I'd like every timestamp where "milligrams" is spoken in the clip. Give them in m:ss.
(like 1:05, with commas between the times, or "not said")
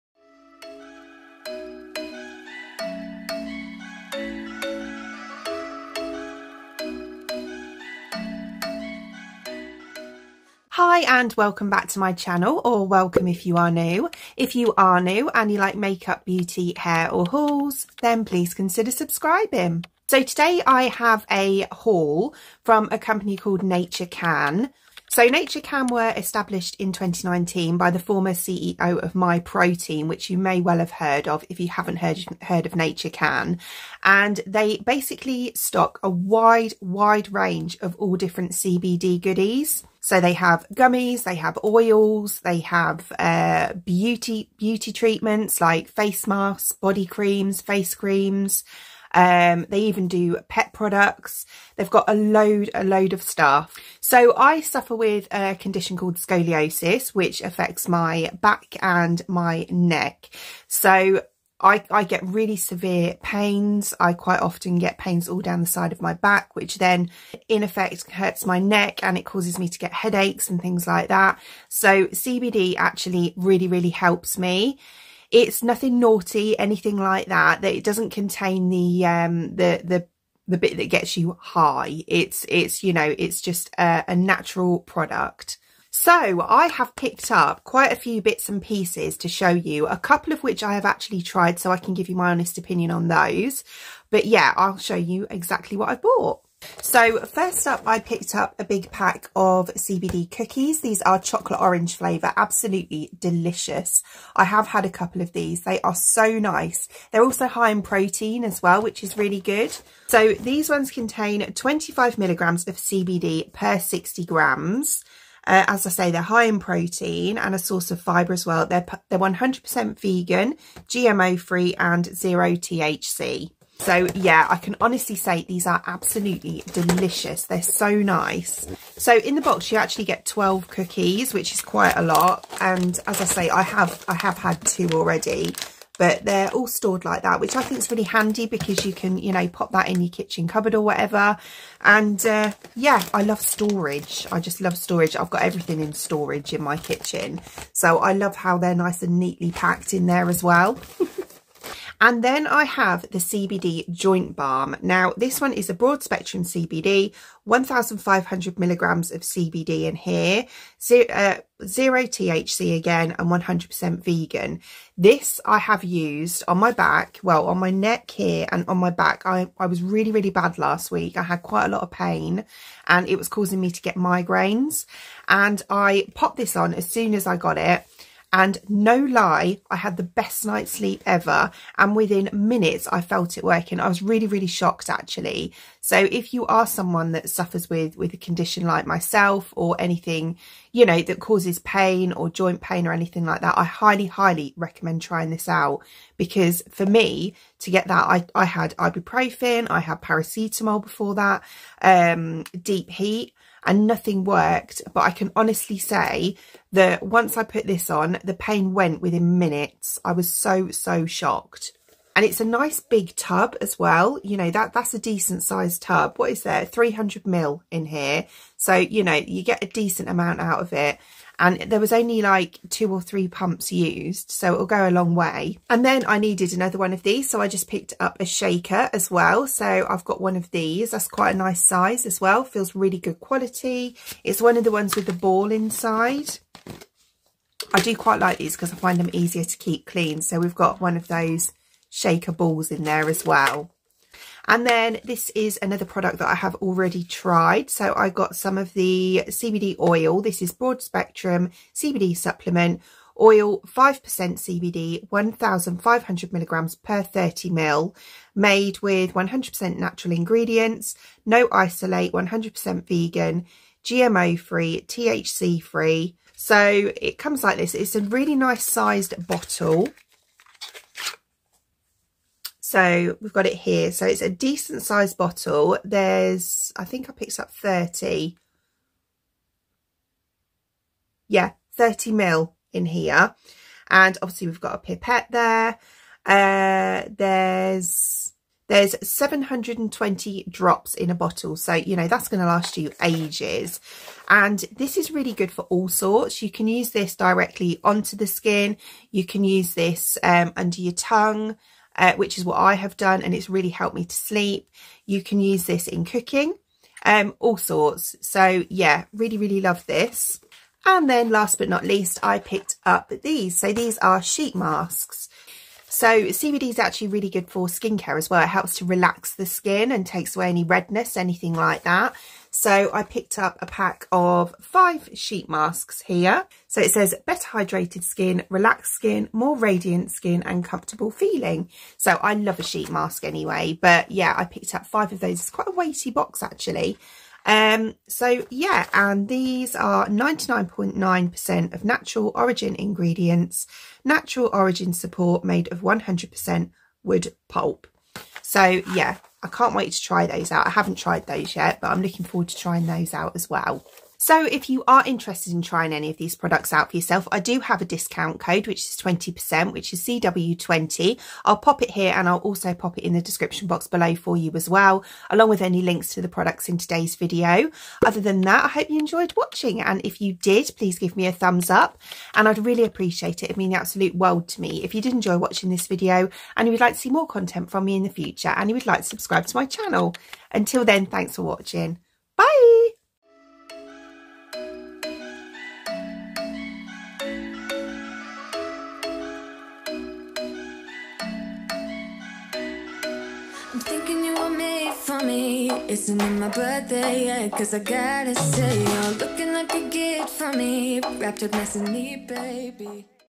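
1:52, 2:38, 4:16.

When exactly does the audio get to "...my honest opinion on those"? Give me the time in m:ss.
1:32.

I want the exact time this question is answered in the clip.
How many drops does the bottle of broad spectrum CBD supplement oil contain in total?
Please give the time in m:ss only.
4:49.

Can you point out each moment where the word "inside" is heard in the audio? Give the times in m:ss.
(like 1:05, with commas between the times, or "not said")
3:55.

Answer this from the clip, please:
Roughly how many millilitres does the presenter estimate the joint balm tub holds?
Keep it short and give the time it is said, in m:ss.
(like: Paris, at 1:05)
300 ml, at 3:36.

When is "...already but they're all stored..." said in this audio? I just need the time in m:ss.
2:14.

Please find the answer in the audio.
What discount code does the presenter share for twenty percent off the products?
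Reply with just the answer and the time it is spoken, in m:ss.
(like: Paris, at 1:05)
CW20, at 6:00.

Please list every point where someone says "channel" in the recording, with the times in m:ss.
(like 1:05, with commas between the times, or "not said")
0:12, 6:19.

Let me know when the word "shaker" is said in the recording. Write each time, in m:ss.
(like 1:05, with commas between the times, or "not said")
3:48, 4:01.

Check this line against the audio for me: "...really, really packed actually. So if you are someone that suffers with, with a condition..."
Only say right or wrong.
wrong.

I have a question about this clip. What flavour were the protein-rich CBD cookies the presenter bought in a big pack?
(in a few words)
Chocolate orange.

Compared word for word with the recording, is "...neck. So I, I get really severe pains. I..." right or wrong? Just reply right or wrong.
right.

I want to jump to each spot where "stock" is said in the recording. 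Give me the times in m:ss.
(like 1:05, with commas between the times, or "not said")
0:35.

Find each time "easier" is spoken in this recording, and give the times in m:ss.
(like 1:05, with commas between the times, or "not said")
3:59.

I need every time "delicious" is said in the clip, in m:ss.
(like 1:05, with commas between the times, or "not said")
1:43, 2:06.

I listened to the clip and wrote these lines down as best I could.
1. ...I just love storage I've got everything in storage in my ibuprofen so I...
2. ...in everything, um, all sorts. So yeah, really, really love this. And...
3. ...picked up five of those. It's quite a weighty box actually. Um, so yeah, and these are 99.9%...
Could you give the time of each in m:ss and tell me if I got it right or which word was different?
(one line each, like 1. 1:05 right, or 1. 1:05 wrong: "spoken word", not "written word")
1. 2:24 wrong: "kitchen", not "ibuprofen"
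2. 5:05 wrong: "cooking", not "everything"
3. 5:34 right.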